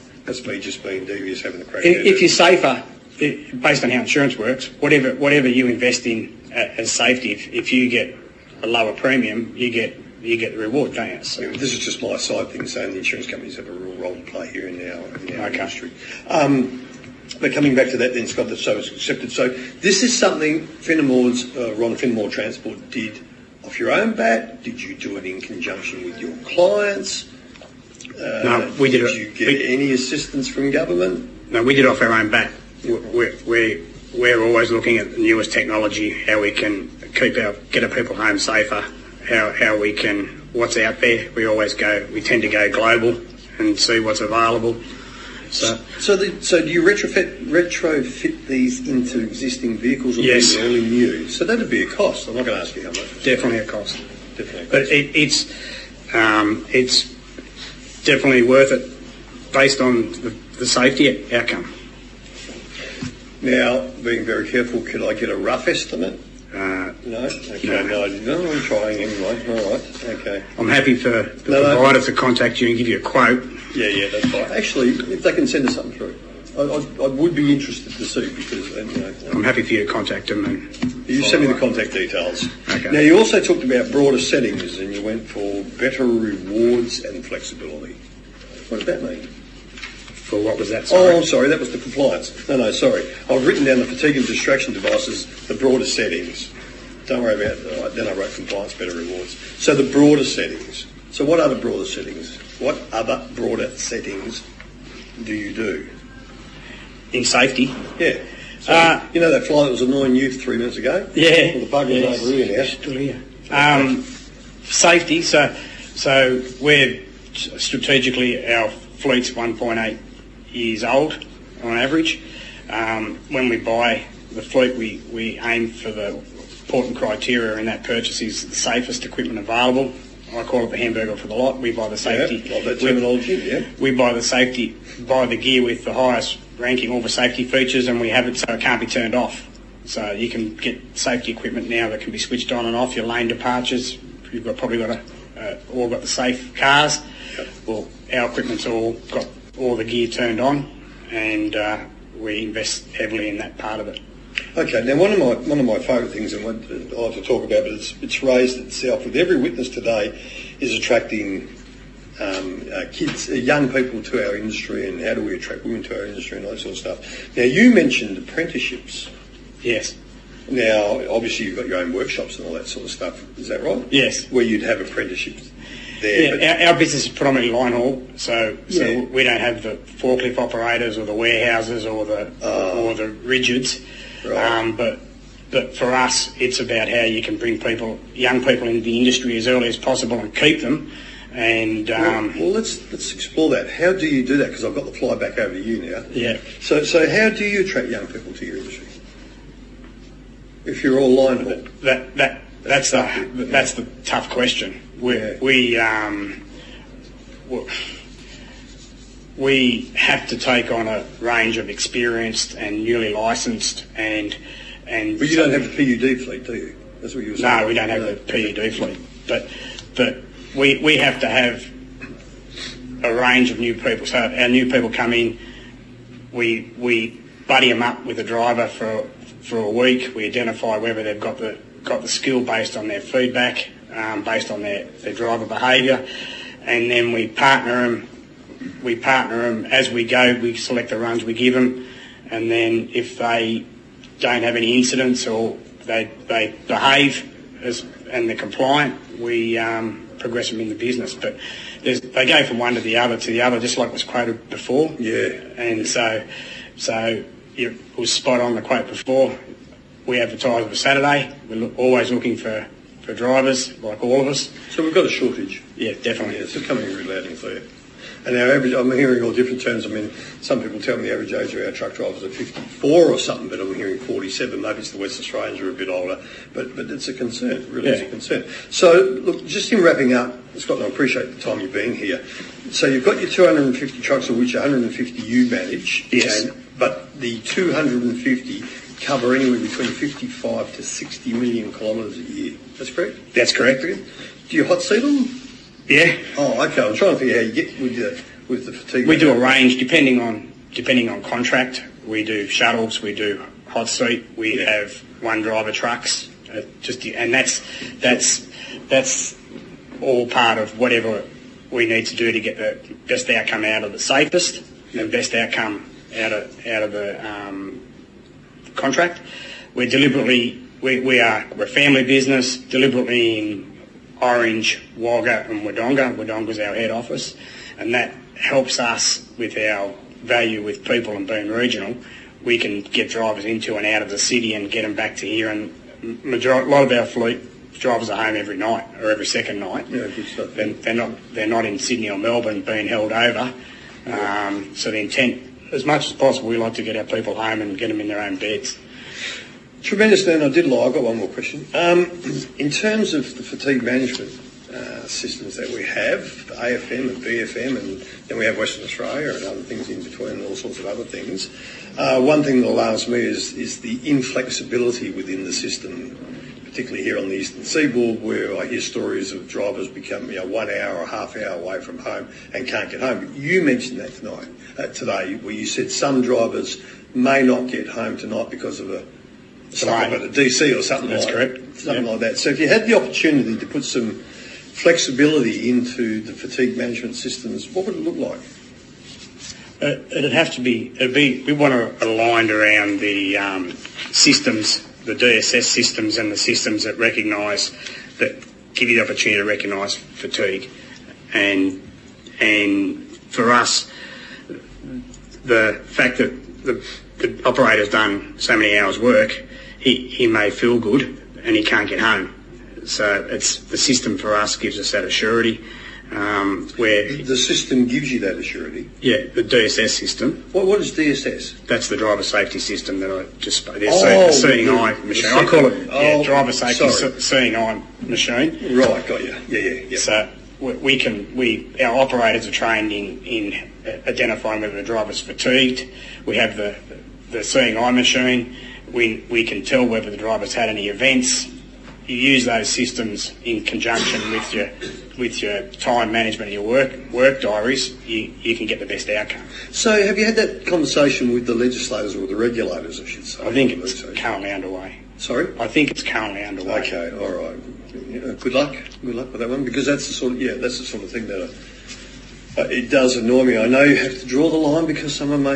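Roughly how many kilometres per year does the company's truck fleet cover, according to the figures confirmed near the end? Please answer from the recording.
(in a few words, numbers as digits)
55 to 60 million.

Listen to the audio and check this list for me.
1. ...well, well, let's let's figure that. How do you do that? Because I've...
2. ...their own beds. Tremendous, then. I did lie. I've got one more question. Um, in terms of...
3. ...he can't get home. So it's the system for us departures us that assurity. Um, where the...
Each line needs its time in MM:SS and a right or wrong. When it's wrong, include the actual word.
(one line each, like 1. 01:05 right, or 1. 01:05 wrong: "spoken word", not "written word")
1. 03:12 wrong: "explore", not "figure"
2. 05:48 right
3. 06:51 wrong: "gives", not "departures".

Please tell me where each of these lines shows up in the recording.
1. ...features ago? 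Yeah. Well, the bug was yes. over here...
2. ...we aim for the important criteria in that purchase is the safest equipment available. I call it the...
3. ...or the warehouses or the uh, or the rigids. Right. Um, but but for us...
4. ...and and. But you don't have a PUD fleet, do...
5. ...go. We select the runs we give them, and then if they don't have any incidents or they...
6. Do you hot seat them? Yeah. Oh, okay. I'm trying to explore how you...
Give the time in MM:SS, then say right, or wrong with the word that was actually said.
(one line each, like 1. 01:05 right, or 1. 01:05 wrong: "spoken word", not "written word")
1. 01:50 wrong: "minutes", not "features"
2. 02:05 right
3. 03:00 right
4. 03:33 right
5. 04:00 right
6. 04:53 wrong: "figure", not "explore".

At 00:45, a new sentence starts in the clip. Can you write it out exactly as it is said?
So, so, the, so do you retrofit retrofit these into existing vehicles or yes.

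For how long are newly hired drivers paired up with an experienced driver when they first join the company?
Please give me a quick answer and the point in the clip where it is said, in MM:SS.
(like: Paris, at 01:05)
a week, at 03:49.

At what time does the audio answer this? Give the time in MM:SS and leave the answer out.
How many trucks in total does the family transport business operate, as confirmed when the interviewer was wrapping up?
04:43.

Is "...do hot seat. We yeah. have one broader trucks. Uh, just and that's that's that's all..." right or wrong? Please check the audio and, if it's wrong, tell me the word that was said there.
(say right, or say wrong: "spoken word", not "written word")
wrong: "driver", not "broader".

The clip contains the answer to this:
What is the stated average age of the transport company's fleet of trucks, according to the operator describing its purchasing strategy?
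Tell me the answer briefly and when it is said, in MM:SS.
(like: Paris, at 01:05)
1.8 years, at 01:59.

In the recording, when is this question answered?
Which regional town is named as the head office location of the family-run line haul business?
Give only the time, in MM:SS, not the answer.
05:26.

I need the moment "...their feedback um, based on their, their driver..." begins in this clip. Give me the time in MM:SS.
03:52.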